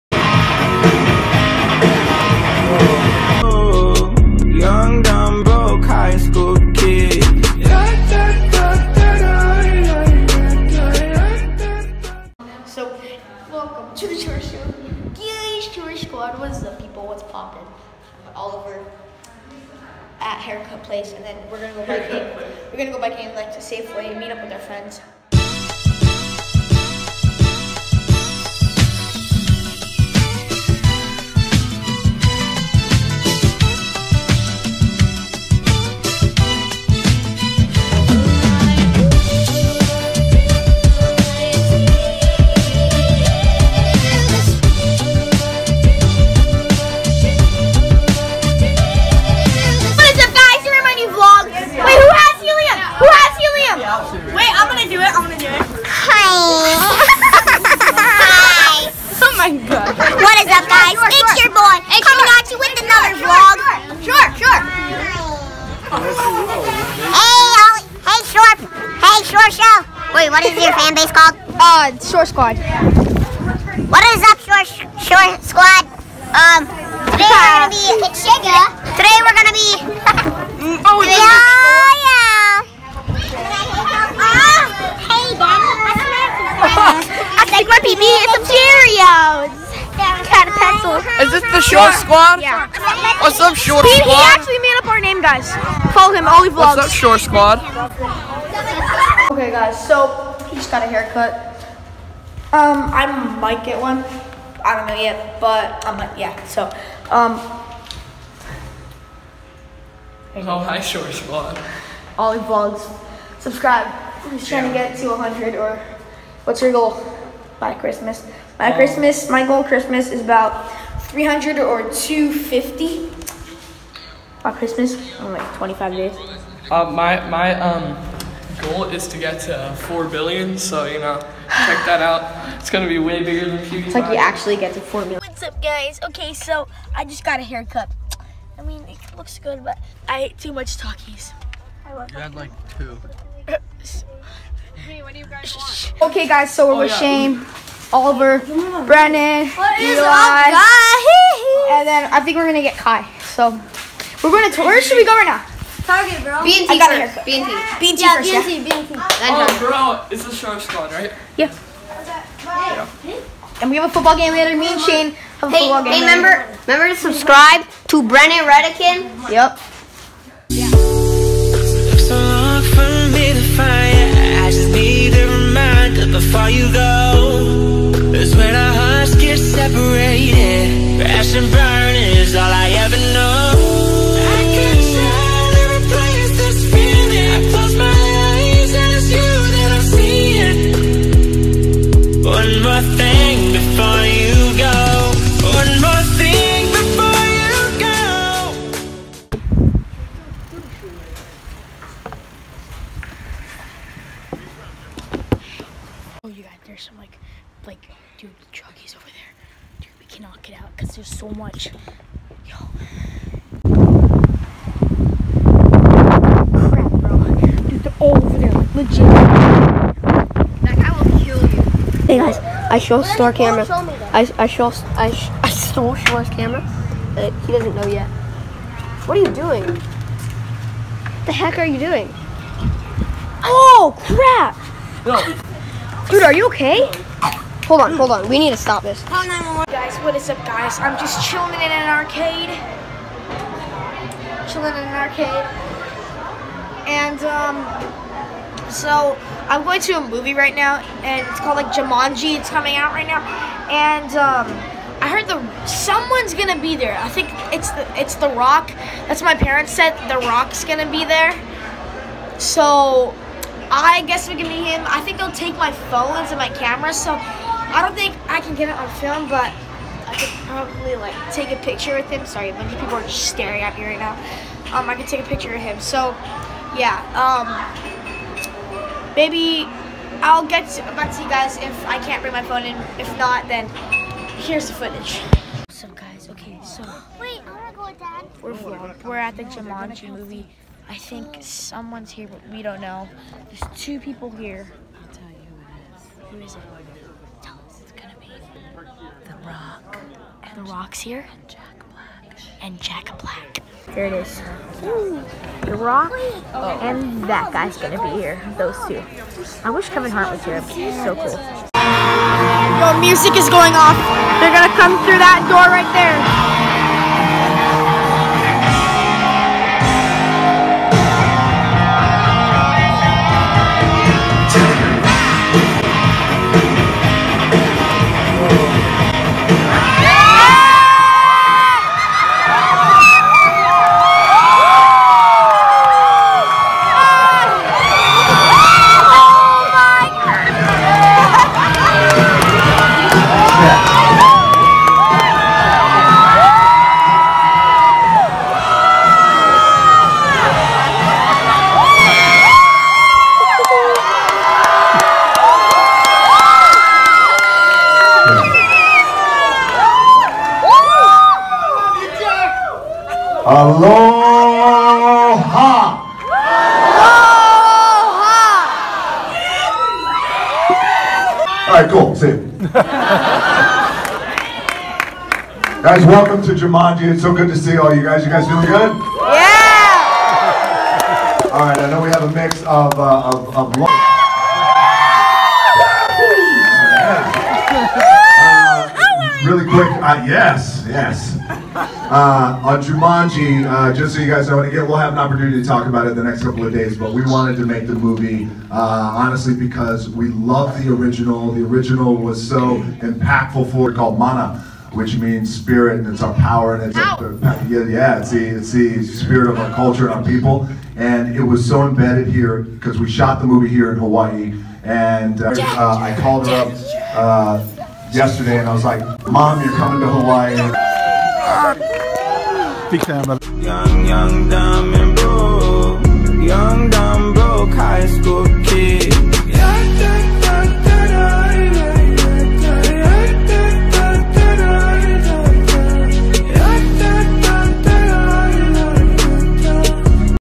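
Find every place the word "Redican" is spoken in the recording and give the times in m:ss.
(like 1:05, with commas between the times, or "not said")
2:48.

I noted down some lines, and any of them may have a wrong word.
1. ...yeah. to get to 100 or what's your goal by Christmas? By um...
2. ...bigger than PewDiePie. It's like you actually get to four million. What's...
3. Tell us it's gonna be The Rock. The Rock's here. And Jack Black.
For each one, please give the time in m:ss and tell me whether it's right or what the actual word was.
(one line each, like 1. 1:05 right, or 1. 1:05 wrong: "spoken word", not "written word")
1. 1:54 right
2. 2:13 right
3. 4:57 right.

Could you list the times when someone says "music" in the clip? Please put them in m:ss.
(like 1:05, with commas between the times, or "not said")
5:13.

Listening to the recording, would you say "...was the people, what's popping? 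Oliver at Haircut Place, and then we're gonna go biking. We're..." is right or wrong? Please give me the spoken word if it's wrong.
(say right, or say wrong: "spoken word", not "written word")
right.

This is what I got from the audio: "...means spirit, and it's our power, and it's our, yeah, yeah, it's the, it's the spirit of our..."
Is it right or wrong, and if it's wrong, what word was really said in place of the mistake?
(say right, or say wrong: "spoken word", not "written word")
right.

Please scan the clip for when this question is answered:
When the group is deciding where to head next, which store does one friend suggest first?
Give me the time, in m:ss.
2:35.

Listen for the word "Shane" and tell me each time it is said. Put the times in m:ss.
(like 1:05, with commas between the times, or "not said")
2:26, 2:44.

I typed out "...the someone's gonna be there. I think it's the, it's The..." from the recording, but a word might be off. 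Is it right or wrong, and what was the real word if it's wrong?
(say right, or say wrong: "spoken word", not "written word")
right.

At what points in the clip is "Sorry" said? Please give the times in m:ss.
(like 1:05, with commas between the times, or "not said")
4:32.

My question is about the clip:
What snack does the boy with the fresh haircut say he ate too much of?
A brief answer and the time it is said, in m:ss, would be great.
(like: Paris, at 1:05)
Takis, at 2:20.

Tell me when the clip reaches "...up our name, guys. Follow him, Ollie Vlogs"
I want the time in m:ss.
1:34.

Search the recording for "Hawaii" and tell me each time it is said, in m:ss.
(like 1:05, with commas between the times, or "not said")
6:53, 7:00.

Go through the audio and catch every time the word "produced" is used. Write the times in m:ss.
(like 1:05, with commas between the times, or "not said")
not said.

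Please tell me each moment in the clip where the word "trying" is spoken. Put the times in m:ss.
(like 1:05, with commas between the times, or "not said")
1:54.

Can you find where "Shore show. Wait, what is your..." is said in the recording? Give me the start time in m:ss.
1:09.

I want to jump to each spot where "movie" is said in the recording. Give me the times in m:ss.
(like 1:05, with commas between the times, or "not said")
4:10, 4:50, 6:37, 6:53.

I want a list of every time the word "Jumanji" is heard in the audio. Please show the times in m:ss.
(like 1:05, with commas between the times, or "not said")
4:11, 4:49, 6:16, 6:32.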